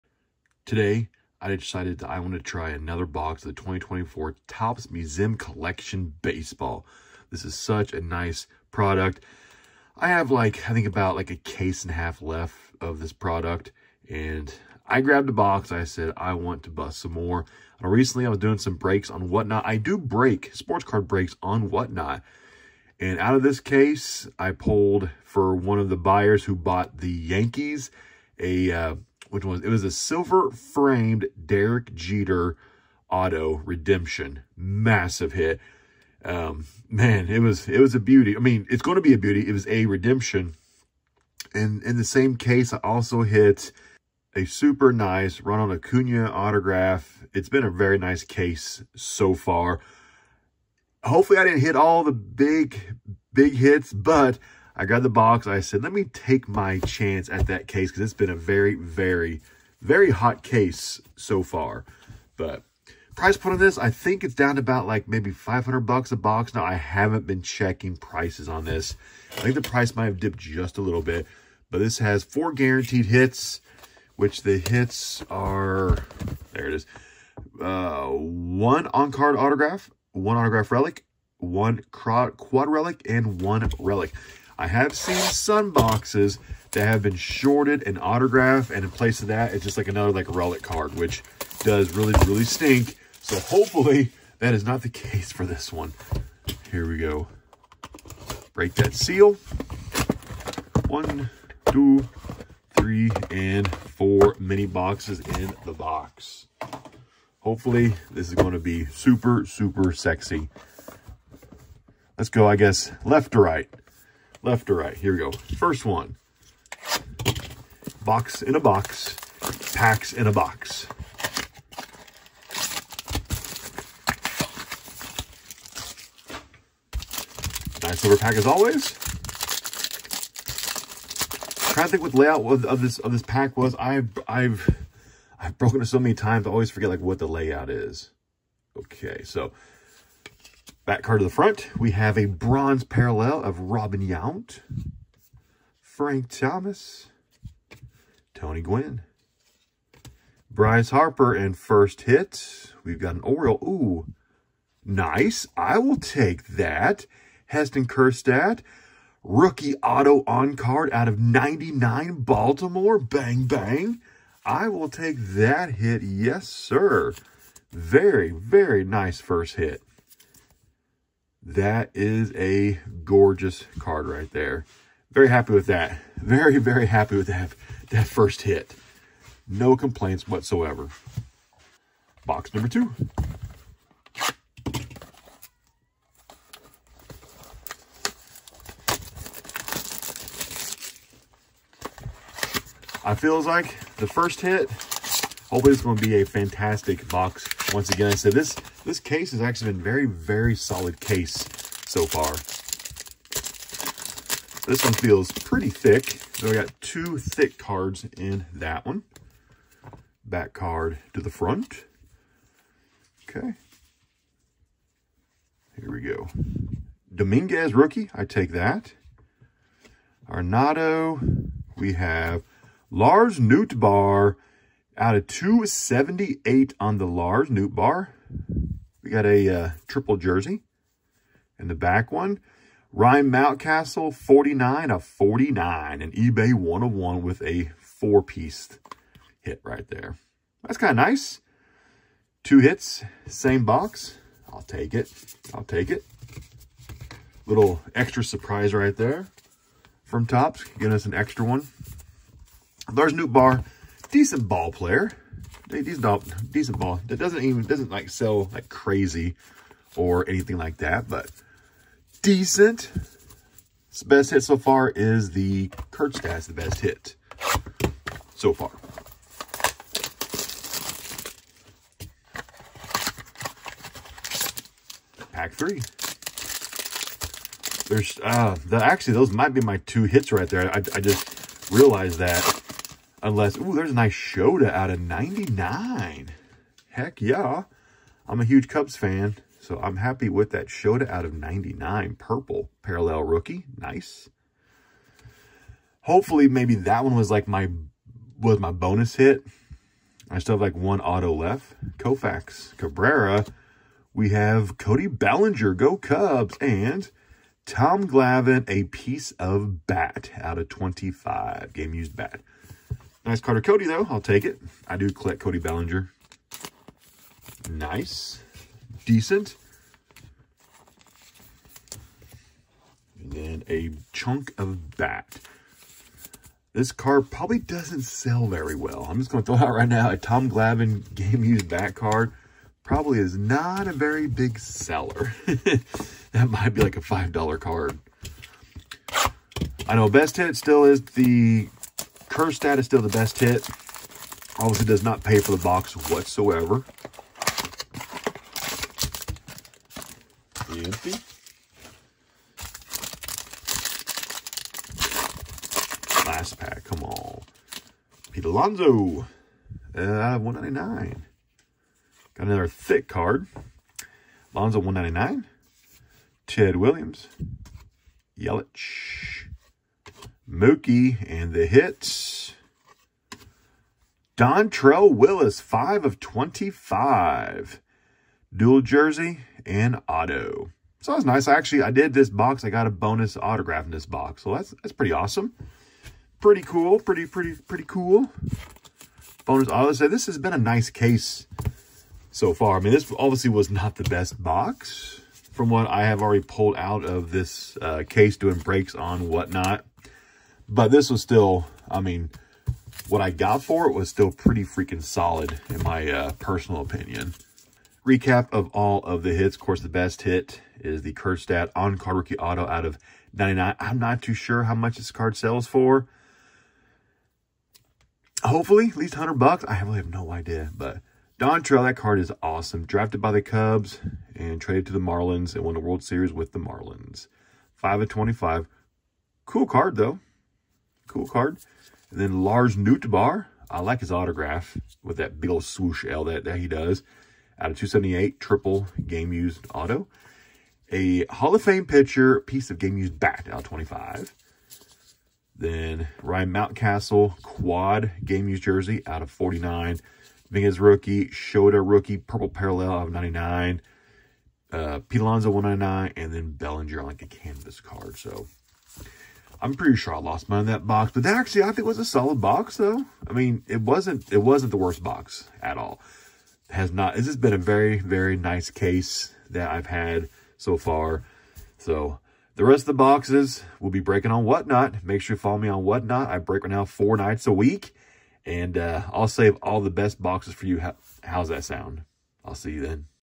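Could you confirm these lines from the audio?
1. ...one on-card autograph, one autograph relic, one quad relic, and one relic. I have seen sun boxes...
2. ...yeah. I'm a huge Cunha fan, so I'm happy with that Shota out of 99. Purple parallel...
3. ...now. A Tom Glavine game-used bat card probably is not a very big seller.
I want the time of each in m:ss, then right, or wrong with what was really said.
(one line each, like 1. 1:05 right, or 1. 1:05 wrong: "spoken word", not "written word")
1. 1:18 right
2. 4:47 wrong: "Cubs", not "Cunha"
3. 5:29 right.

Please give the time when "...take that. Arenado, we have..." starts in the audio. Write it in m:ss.
3:38.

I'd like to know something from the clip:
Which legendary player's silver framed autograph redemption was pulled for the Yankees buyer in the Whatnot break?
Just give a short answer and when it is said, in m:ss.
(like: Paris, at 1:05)
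Derek Jeter, at 0:31.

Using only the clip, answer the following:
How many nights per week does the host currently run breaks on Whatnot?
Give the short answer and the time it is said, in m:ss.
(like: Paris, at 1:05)
4, at 7:56.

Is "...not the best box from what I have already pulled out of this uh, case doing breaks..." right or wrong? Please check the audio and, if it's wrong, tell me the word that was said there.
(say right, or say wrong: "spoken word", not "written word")
right.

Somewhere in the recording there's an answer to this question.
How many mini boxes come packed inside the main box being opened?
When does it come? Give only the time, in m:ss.
1:43.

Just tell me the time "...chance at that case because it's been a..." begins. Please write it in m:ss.
0:56.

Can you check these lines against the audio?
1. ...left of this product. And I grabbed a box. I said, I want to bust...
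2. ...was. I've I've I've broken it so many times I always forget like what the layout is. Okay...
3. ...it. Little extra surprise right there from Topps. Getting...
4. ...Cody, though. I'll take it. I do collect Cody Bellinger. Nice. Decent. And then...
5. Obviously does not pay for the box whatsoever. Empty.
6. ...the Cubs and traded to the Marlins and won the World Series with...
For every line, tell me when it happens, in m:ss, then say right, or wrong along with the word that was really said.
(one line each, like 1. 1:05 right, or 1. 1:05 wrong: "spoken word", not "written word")
1. 0:12 right
2. 2:13 right
3. 4:05 right
4. 5:13 right
5. 5:44 right
6. 7:03 right.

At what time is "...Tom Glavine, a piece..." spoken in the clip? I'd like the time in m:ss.
5:07.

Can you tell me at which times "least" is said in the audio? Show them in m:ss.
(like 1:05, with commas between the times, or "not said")
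6:58.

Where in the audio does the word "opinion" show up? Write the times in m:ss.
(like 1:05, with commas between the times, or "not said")
6:46.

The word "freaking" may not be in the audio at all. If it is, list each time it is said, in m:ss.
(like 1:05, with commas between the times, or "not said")
6:44.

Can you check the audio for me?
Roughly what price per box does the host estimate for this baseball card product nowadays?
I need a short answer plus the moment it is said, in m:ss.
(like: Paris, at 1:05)
$500, at 1:05.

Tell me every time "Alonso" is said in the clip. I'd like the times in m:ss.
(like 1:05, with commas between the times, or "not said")
5:58, 6:04, 7:35.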